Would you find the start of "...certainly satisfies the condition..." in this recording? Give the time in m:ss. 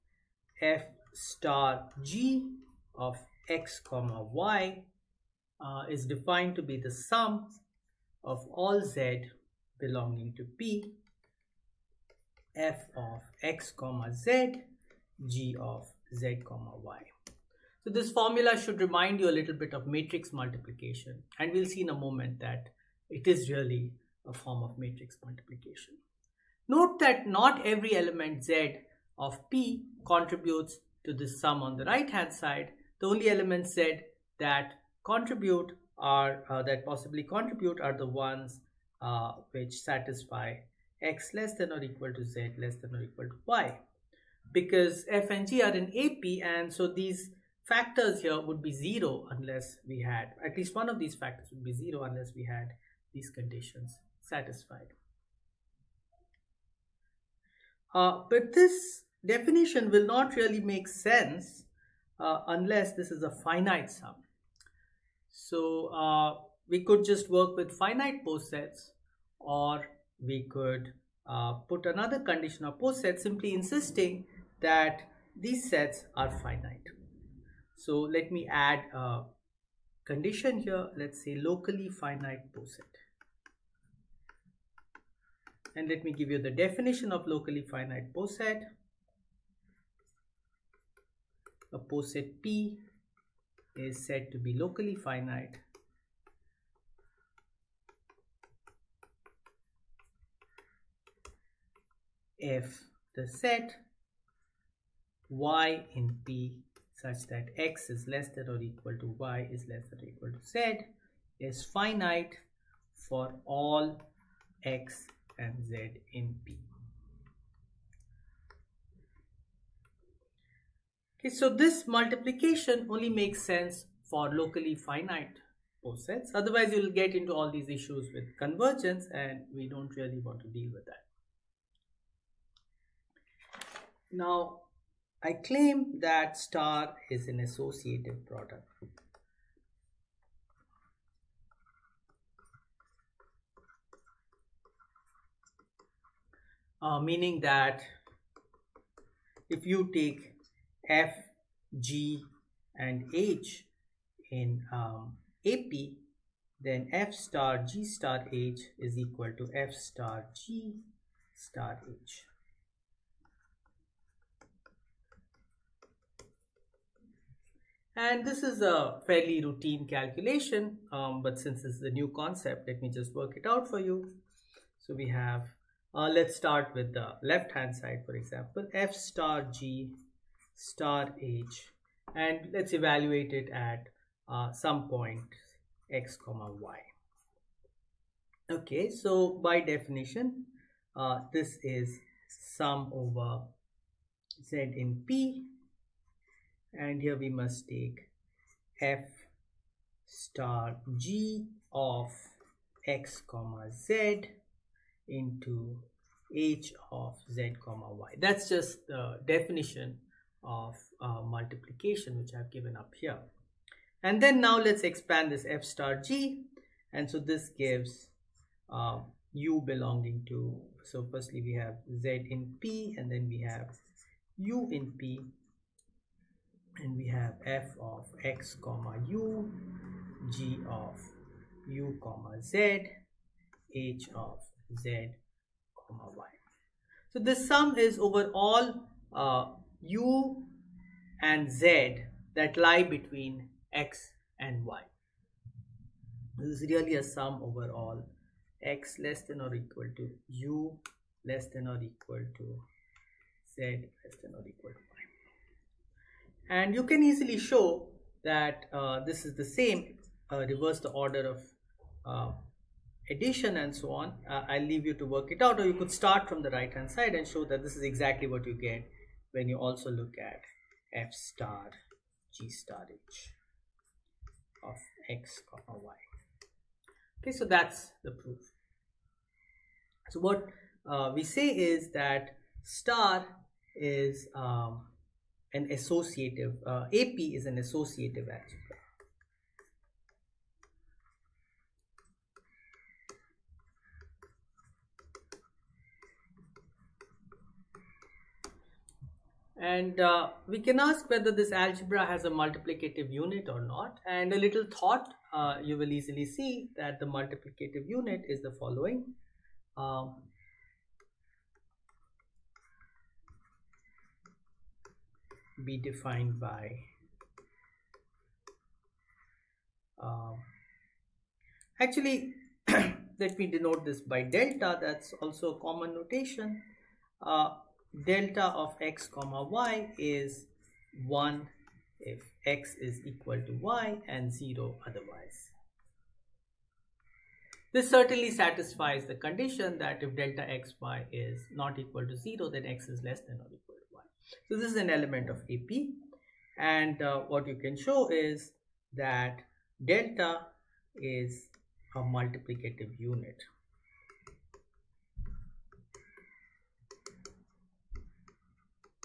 5:37.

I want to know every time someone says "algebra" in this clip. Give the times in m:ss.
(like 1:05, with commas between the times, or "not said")
4:48, 5:01.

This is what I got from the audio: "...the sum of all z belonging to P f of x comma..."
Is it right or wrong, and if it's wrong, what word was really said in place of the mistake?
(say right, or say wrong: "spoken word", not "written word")
right.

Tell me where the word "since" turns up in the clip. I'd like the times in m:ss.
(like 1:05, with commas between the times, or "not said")
2:51.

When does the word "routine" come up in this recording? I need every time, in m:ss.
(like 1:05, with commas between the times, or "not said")
2:49.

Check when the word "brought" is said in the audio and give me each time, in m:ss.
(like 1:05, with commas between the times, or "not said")
not said.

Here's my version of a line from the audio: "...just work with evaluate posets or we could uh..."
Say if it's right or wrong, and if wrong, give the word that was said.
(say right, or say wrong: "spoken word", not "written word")
wrong: "finite", not "evaluate".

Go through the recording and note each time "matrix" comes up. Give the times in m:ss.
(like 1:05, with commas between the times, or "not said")
0:19, 0:24.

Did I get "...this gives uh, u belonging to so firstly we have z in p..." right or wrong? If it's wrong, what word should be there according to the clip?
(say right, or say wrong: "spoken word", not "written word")
right.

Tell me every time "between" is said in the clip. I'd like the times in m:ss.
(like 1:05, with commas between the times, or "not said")
4:02.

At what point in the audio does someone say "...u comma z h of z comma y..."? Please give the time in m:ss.
3:51.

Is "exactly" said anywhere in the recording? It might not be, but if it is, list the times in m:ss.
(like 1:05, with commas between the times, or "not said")
4:27.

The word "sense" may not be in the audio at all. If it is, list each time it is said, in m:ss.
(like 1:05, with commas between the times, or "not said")
1:00, 2:03.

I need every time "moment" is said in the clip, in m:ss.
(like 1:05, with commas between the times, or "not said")
0:21.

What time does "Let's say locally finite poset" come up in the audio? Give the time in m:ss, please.
1:20.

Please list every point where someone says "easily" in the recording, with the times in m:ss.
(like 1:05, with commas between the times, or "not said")
4:17, 5:05.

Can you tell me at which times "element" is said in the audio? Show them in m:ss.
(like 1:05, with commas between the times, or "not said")
0:27, 0:33, 5:44.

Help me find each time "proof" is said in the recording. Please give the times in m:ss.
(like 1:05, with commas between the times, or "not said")
4:38.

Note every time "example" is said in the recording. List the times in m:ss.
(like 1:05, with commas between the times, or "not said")
2:58.